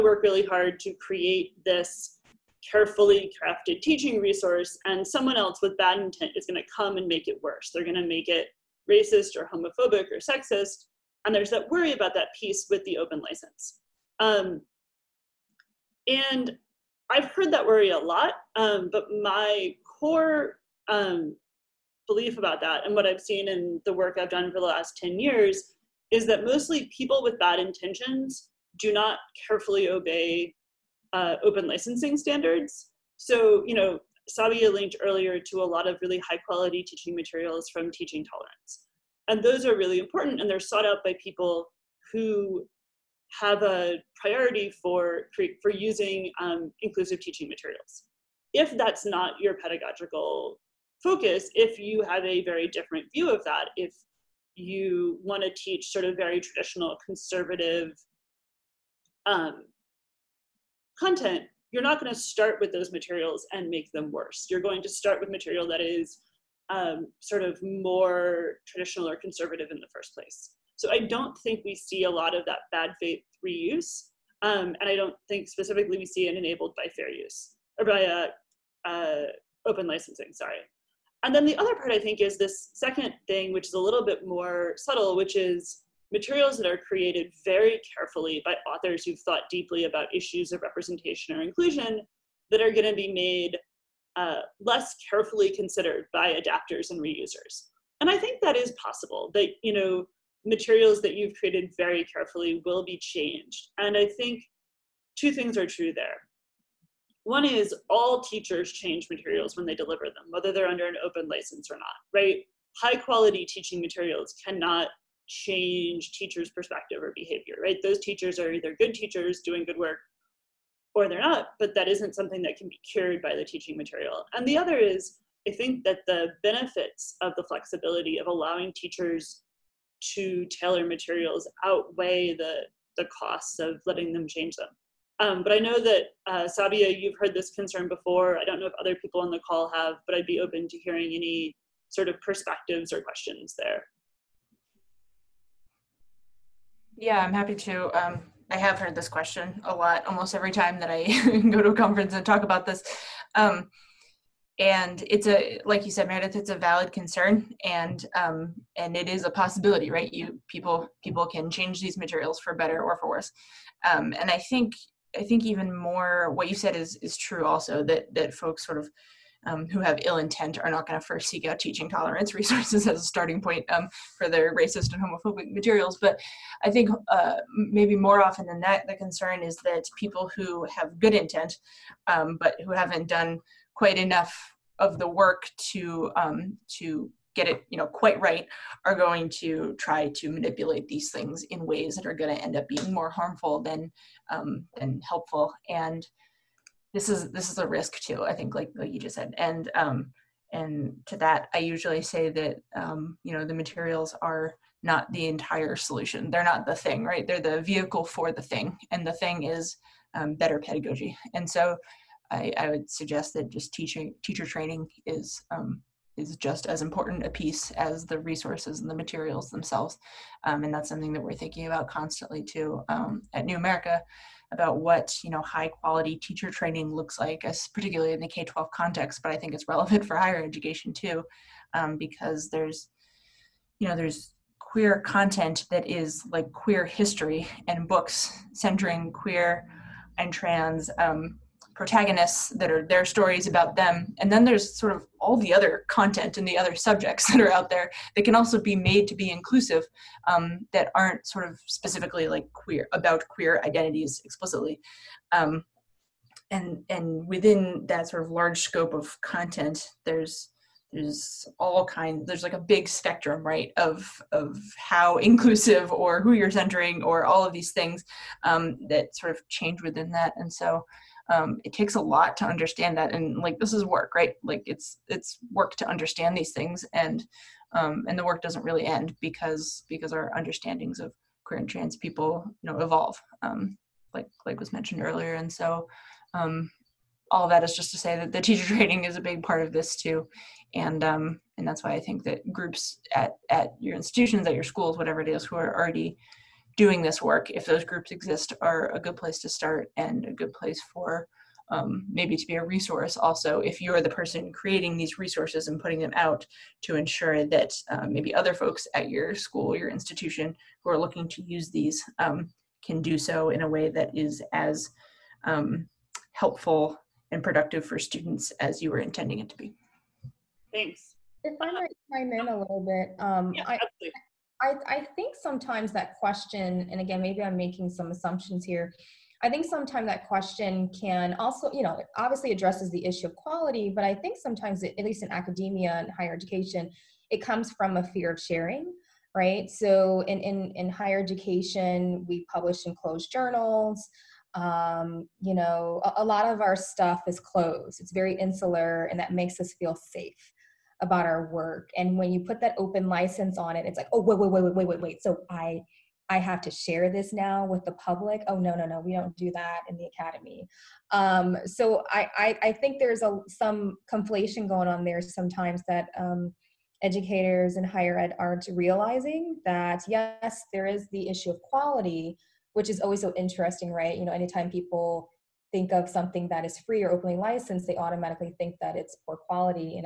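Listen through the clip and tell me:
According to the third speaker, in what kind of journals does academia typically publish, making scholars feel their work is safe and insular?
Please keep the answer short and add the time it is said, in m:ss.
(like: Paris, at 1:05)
Closed journals, at 5:42.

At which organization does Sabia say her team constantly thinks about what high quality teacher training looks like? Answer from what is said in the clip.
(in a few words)
New America.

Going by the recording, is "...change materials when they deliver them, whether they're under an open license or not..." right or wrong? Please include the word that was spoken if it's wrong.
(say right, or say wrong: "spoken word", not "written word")
right.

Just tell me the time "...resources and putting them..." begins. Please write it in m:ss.
5:05.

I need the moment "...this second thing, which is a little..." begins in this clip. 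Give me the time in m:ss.
1:22.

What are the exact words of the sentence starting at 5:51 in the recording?
And when you put that open license on it, it's like, oh, wait, wait, wait, wait, wait, wait, wait.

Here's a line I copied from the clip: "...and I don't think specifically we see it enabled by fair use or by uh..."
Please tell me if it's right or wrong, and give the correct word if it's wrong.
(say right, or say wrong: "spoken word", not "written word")
right.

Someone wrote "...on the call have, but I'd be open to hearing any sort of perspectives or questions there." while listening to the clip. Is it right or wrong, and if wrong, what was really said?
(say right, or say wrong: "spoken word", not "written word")
right.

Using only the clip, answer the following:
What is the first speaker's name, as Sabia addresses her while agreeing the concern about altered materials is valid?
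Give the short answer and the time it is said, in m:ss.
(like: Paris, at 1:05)
Meredith, at 2:36.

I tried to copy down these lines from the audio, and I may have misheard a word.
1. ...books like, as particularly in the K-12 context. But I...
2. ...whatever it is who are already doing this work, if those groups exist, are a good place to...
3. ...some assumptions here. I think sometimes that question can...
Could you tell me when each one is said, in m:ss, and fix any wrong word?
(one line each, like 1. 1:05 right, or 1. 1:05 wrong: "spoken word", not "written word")
1. 3:46 wrong: "looks", not "books"
2. 4:54 right
3. 5:27 right.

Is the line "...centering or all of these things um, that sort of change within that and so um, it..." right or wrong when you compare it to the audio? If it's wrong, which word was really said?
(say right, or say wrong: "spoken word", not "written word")
right.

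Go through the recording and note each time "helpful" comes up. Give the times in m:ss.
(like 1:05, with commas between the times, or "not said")
3:15, 5:16.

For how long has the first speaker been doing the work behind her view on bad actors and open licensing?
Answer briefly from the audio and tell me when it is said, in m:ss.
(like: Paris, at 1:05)
10 years, at 0:24.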